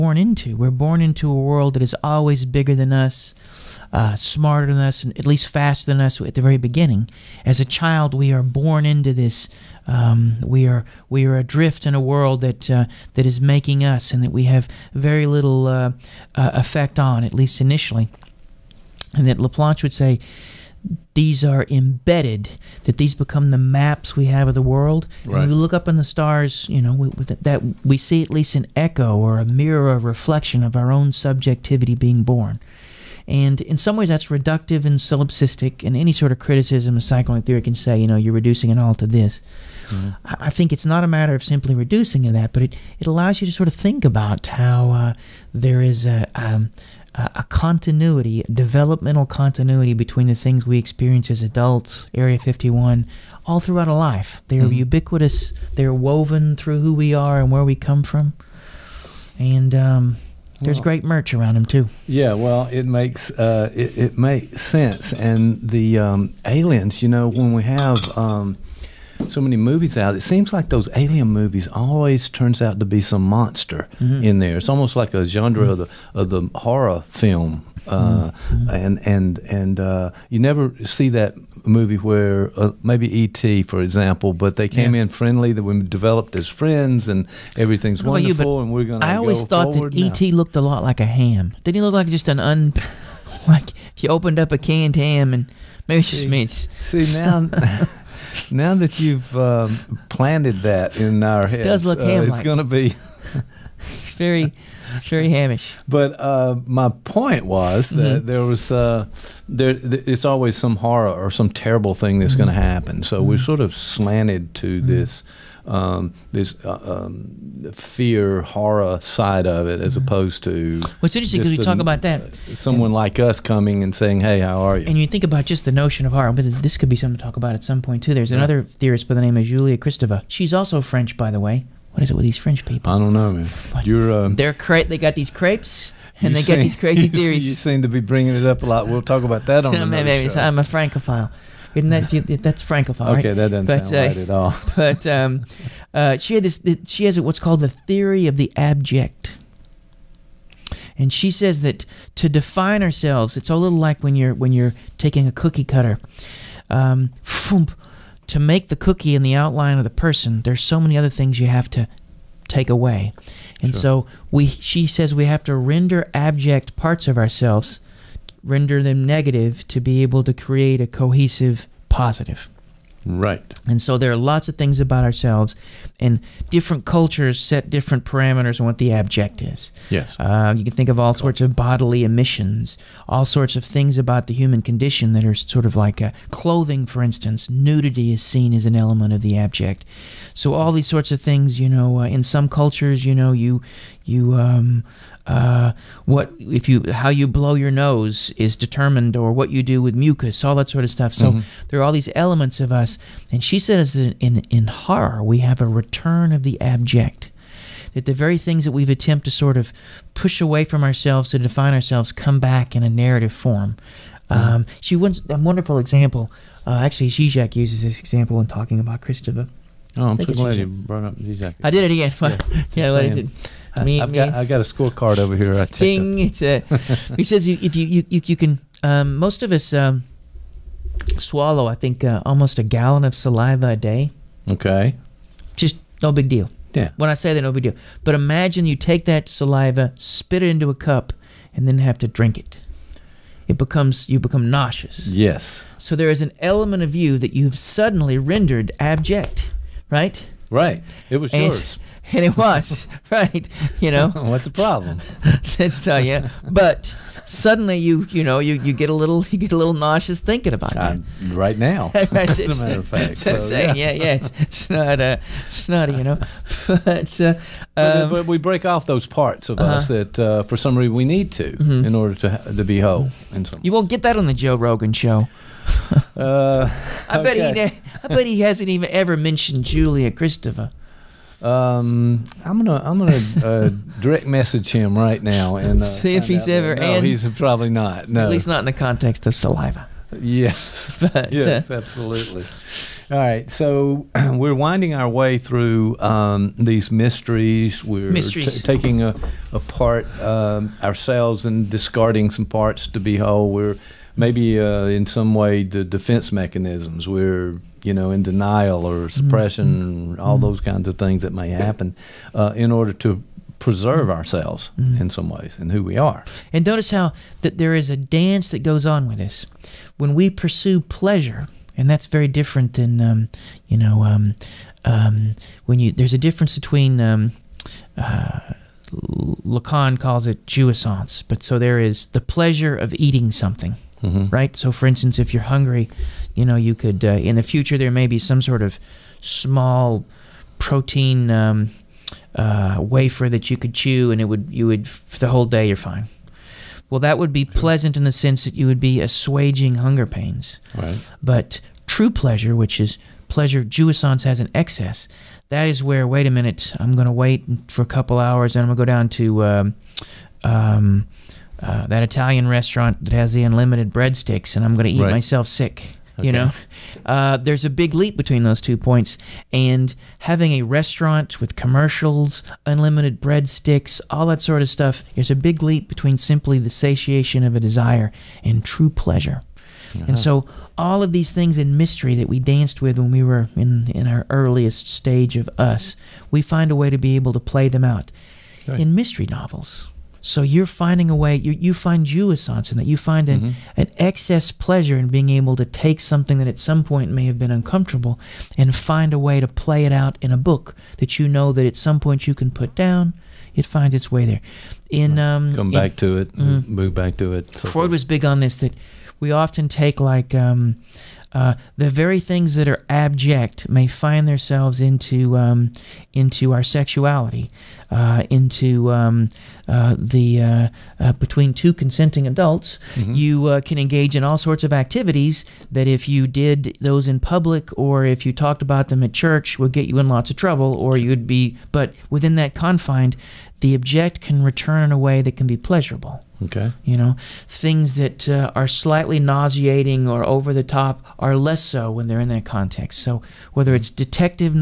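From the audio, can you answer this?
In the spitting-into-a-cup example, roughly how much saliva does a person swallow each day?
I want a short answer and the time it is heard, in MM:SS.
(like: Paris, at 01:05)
a gallon, at 03:52.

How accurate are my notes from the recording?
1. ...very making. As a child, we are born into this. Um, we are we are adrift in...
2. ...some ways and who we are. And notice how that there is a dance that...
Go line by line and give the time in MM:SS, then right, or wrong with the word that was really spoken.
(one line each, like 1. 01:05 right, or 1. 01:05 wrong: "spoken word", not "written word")
1. 00:06 wrong: "beginning", not "making"
2. 05:15 right.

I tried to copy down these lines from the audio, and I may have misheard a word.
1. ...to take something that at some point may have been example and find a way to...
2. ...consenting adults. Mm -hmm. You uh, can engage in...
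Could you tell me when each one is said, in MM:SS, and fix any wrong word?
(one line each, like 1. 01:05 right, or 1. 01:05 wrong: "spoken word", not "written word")
1. 06:35 wrong: "uncomfortable", not "example"
2. 07:01 right.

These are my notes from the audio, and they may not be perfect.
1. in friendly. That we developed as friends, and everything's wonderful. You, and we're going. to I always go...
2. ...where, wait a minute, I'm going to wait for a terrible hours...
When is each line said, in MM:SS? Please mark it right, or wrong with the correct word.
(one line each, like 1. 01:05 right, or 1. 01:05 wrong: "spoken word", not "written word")
1. 01:25 right
2. 05:55 wrong: "couple", not "terrible".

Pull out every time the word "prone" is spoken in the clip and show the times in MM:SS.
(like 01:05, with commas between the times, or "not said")
not said.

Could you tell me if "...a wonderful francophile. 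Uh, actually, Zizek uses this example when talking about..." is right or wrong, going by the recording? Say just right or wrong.
wrong.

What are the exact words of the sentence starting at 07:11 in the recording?
But within that confined, the object can return in a way that can be pleasurable.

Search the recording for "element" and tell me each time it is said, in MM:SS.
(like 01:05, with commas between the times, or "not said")
03:08, 03:22, 04:06.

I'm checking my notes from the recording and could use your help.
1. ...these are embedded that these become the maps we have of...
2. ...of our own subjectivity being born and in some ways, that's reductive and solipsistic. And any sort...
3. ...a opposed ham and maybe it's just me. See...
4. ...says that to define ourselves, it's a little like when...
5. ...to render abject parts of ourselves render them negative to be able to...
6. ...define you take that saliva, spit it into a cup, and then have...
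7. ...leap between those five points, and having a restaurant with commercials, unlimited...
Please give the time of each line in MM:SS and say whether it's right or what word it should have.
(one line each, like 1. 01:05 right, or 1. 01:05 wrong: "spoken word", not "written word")
1. 00:21 right
2. 00:30 right
3. 01:34 wrong: "canned", not "opposed"
4. 02:31 right
5. 02:45 right
6. 03:58 wrong: "imagine", not "define"
7. 06:07 wrong: "two", not "five".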